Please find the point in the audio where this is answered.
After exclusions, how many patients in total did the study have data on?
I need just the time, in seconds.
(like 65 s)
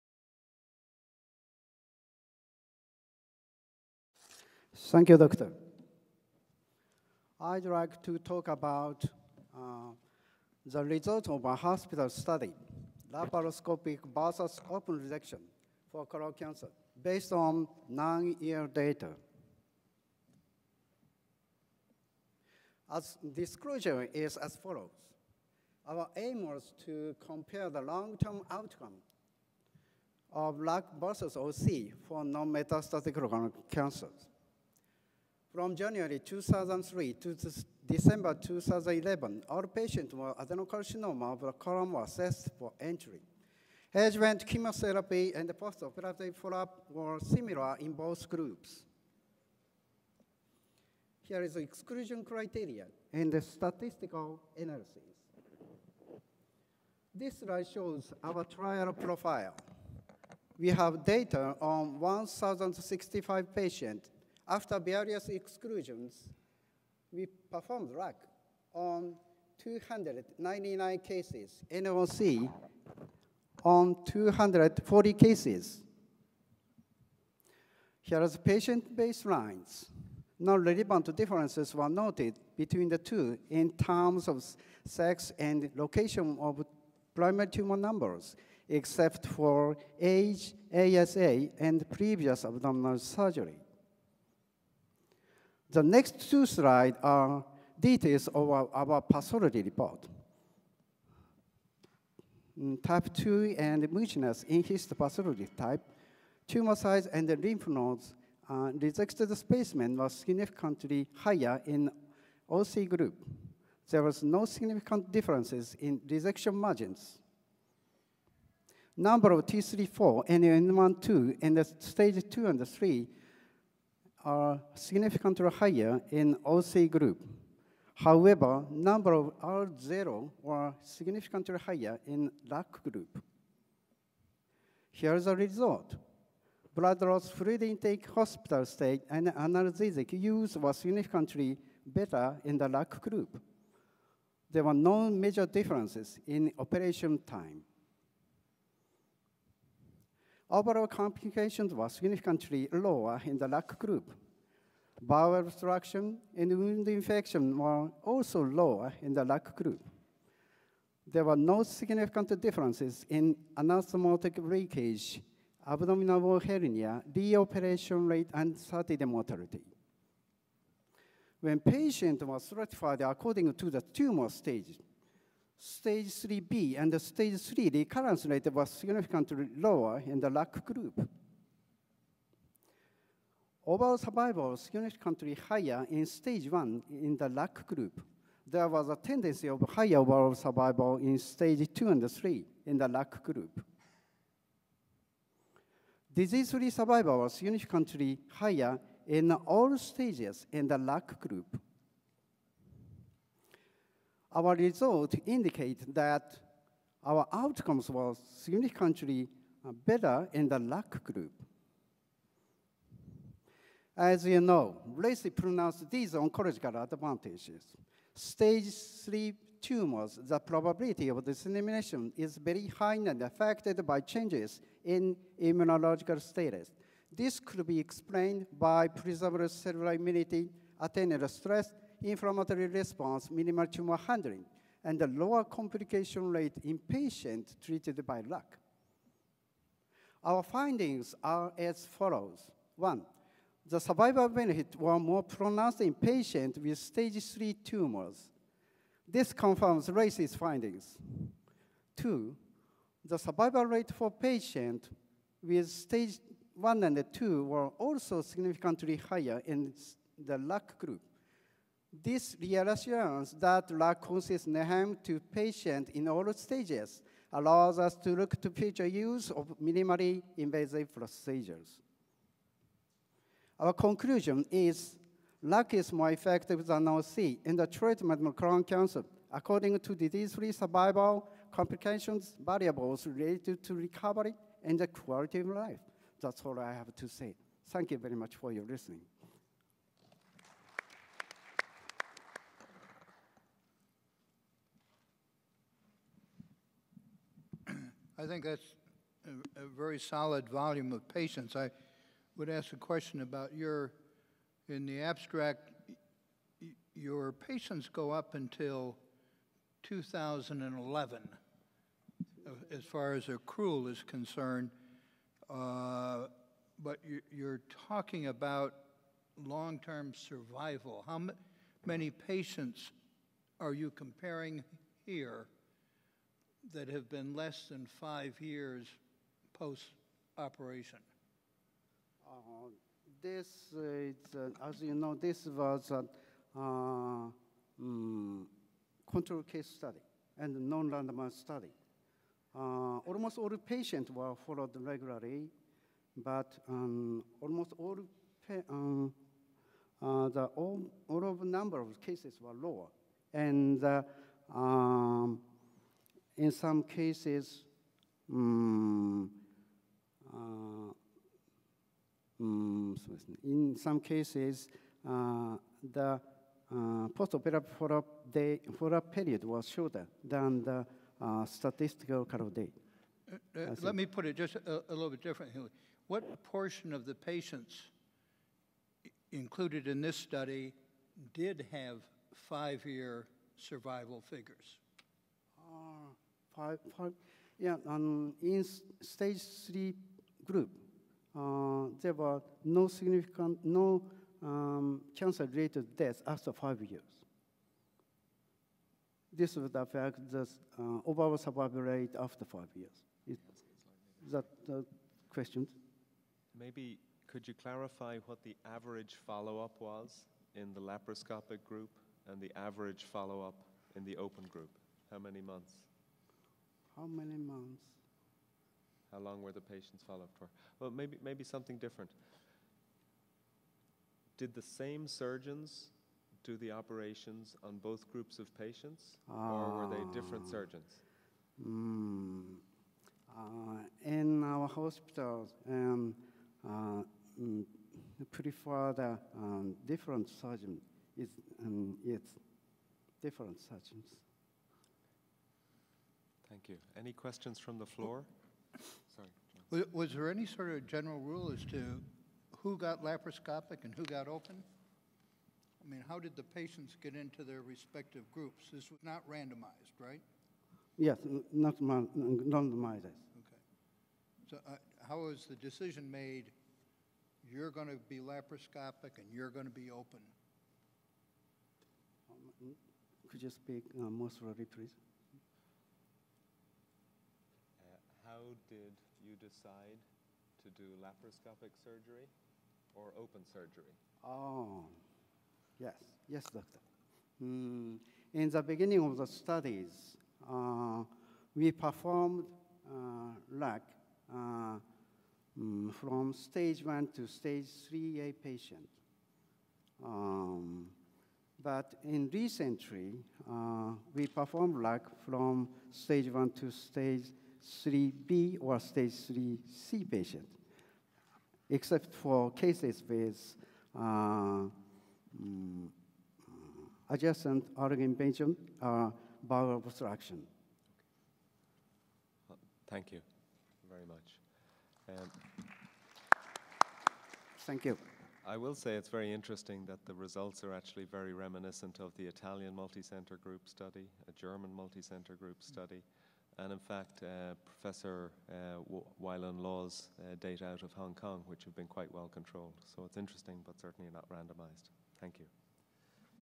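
61 s.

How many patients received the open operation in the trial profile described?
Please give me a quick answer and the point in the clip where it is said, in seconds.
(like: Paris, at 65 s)
240, at 74 s.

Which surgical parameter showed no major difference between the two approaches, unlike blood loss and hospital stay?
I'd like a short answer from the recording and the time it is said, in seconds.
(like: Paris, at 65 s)
Operation time, at 146 s.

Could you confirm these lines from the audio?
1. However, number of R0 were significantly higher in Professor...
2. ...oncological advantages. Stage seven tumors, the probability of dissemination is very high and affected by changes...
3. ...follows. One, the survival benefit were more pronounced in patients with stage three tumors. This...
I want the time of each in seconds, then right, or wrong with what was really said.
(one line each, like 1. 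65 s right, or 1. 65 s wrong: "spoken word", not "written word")
1. 127 s wrong: "LAC", not "Professor"
2. 216 s wrong: "three", not "seven"
3. 241 s right.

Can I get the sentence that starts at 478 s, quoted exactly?
how did you decide to do laparoscopic surgery or open surgery?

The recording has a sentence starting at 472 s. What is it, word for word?
Um, could you speak uh, more slowly, please?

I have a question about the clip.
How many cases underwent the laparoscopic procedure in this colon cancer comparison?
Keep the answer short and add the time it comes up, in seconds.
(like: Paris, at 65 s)
299, at 69 s.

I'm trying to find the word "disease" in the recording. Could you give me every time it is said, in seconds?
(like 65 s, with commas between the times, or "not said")
196 s, 279 s.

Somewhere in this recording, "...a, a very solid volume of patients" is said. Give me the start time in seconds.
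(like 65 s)
299 s.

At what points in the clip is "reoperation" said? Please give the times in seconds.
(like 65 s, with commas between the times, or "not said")
167 s.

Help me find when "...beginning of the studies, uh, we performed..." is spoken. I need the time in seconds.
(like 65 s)
488 s.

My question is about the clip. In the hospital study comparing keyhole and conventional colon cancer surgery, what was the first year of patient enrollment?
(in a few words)
2003.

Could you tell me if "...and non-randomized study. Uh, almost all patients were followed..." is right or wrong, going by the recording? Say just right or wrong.
right.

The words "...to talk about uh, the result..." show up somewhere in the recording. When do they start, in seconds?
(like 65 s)
8 s.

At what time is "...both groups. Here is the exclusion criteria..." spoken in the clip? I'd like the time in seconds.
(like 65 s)
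47 s.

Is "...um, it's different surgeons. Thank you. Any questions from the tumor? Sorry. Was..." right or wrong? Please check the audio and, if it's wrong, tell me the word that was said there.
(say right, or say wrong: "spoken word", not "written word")
wrong: "floor", not "tumor".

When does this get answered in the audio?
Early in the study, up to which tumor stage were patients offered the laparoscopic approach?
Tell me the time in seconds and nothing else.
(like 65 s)
497 s.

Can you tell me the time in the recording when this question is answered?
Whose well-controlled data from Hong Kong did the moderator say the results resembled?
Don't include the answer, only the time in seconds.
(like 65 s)
539 s.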